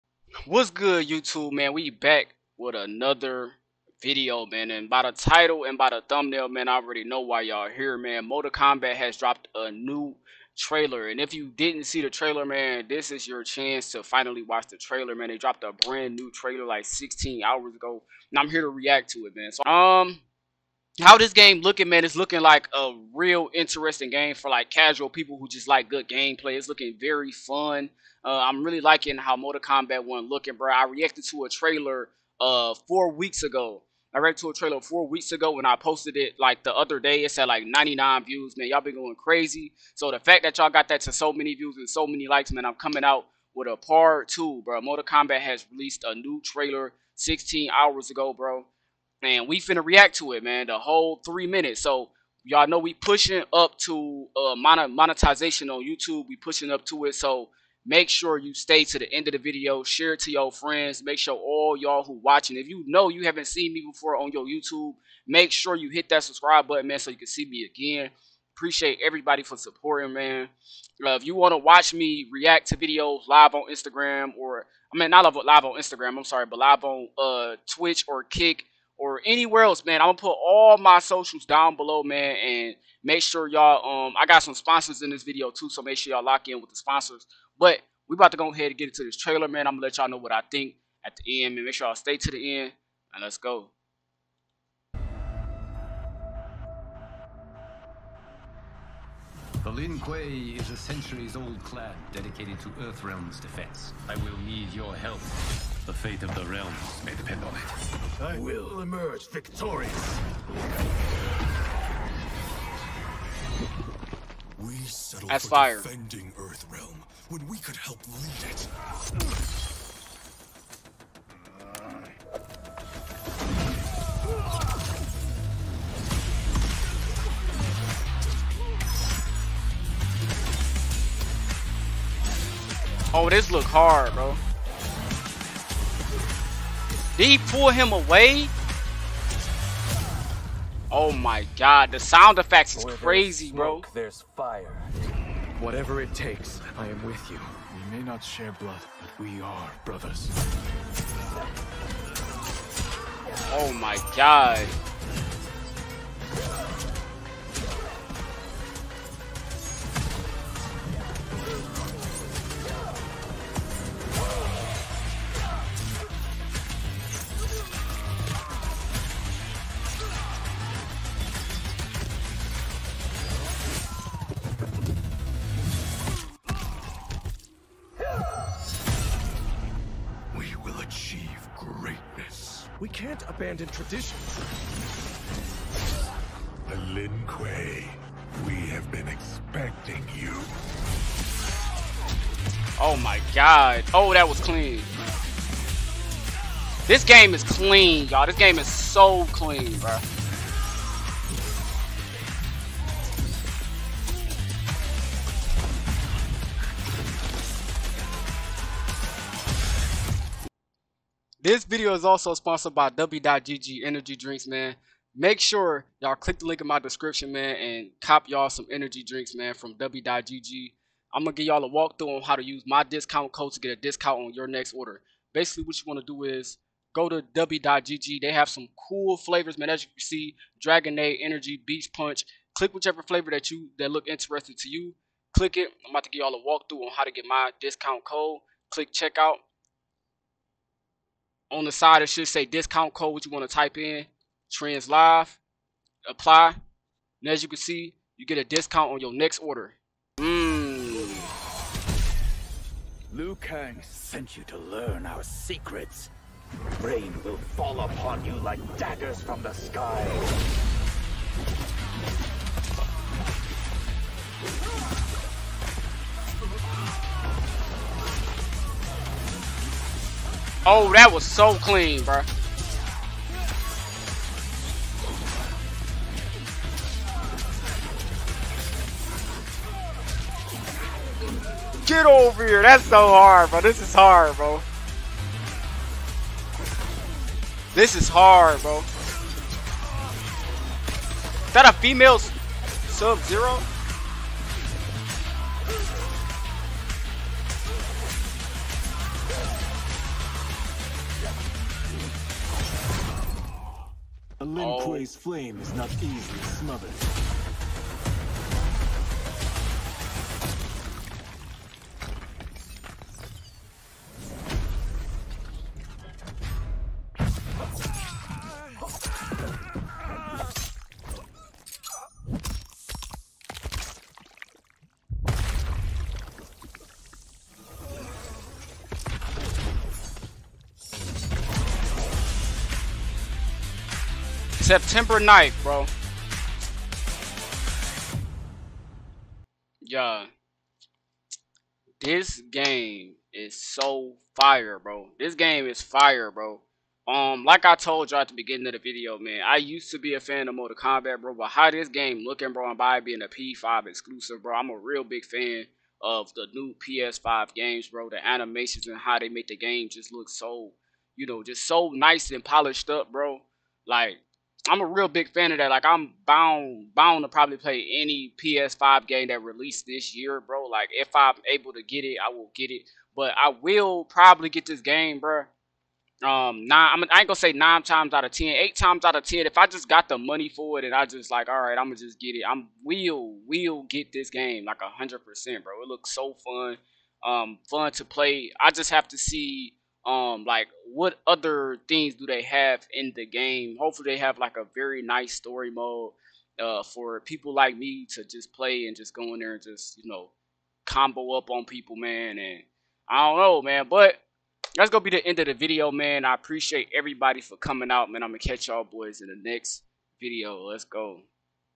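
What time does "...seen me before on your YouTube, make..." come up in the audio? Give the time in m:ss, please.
1:03.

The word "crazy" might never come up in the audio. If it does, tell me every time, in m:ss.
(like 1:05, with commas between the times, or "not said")
0:39, 2:22.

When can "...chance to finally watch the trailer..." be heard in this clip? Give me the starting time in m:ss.
0:13.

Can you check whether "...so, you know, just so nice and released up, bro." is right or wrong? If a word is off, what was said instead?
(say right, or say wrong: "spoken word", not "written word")
wrong: "polished", not "released".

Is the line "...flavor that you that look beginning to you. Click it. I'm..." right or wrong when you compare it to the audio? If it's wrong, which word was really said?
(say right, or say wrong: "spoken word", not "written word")
wrong: "interesting", not "beginning".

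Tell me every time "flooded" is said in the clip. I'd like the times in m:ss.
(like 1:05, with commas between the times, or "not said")
not said.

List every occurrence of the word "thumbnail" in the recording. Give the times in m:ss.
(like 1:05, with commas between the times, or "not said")
0:06.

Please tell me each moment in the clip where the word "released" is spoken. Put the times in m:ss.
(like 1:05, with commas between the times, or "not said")
0:45, 6:09.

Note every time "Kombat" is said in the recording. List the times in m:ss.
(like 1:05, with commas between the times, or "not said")
0:08, 0:29, 0:45, 5:50.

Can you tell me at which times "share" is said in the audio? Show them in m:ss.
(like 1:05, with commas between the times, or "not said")
0:59, 2:28.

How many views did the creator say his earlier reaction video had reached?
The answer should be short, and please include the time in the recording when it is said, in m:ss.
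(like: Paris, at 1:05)
99, at 0:37.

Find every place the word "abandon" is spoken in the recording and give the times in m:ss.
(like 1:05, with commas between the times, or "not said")
3:03.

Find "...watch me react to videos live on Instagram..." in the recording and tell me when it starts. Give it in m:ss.
1:11.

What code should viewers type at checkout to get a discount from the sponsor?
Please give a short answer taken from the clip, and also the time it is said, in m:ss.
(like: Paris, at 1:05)
trends live, at 4:04.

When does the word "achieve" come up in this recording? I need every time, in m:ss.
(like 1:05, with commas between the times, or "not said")
3:00.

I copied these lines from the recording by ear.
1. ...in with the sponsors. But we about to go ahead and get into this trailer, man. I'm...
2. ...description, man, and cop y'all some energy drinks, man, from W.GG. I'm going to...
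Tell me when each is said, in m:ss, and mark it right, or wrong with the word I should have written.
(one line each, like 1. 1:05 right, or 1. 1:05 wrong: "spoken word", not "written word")
1. 1:26 right
2. 3:36 right.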